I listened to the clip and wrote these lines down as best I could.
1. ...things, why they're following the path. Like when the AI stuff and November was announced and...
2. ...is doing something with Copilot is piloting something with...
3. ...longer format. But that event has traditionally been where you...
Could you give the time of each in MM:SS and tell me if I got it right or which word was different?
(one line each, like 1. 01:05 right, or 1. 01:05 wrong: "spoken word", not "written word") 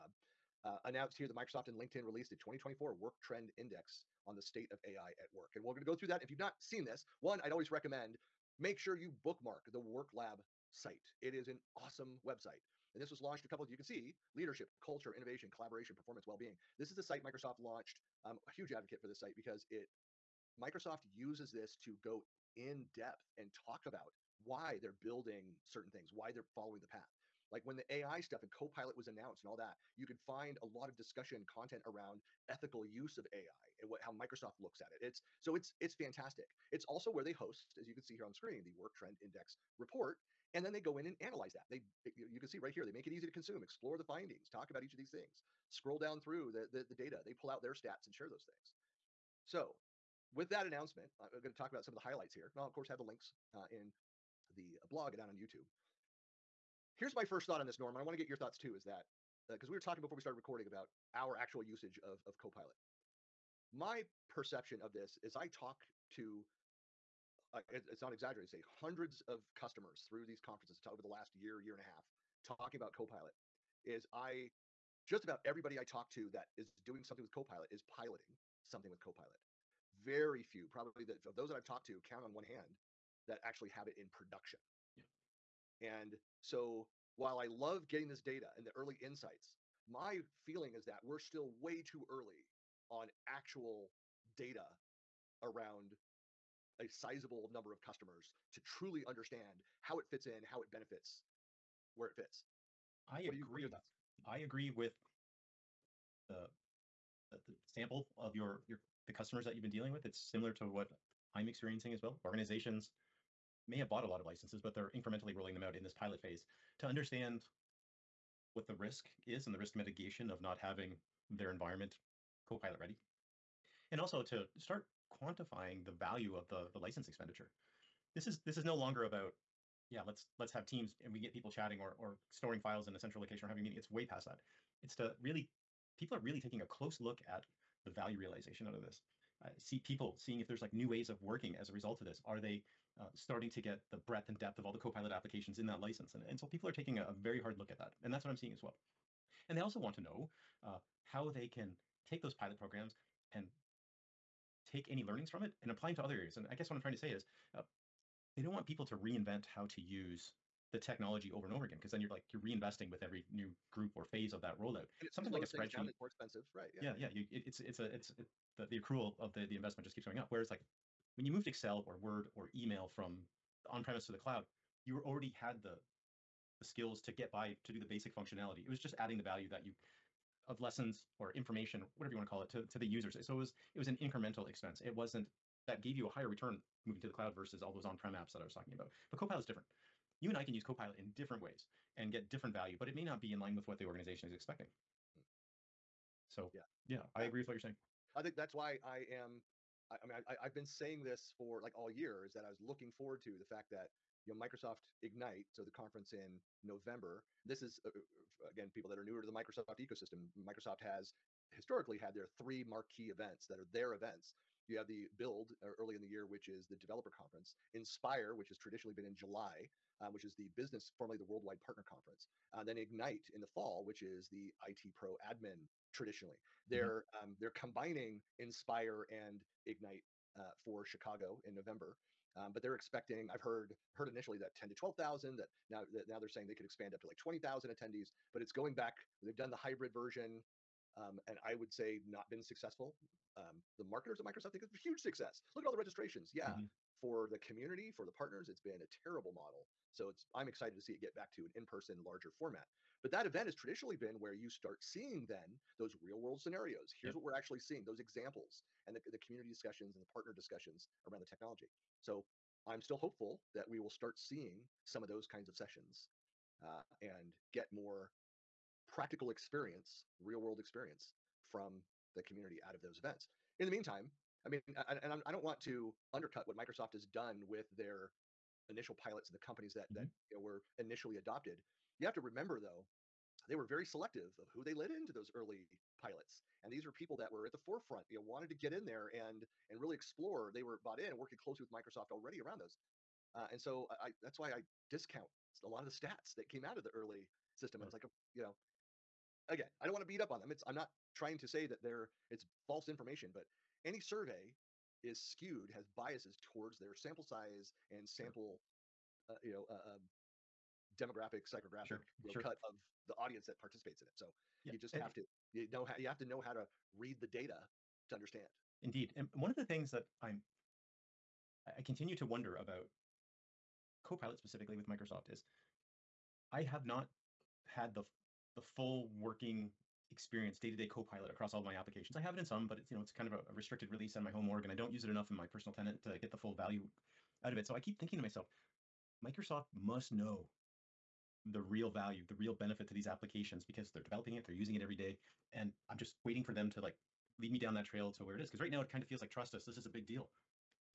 1. 00:25 wrong: "Copilot", not "November"
2. 01:16 right
3. 04:12 wrong: "larger", not "longer".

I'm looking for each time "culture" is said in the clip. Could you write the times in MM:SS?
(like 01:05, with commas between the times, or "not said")
00:14.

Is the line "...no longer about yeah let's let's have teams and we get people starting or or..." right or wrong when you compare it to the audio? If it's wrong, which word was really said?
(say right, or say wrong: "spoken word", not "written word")
wrong: "chatting", not "starting".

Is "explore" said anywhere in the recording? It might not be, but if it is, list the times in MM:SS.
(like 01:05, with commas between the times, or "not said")
00:43, 04:49.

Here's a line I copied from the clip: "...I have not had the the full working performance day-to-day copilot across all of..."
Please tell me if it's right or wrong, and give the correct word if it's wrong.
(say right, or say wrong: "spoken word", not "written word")
wrong: "experience", not "performance".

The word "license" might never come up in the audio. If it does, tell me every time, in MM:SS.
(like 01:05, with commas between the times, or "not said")
01:54, 02:06, 02:25.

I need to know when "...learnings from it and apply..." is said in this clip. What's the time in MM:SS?
02:35.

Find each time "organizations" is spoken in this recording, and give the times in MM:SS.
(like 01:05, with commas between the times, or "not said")
01:52, 03:13.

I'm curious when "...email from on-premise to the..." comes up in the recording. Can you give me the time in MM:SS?
02:52.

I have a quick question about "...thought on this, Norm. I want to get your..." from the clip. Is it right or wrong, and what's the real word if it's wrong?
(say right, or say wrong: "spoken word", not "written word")
right.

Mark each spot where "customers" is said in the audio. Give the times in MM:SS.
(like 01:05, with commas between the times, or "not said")
01:09, 01:37, 01:49.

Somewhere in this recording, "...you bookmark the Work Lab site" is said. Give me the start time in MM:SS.
00:08.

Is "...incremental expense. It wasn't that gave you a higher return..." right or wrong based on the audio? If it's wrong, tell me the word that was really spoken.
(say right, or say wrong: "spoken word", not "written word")
right.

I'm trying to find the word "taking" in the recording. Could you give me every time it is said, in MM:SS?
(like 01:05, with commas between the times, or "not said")
02:16, 02:26.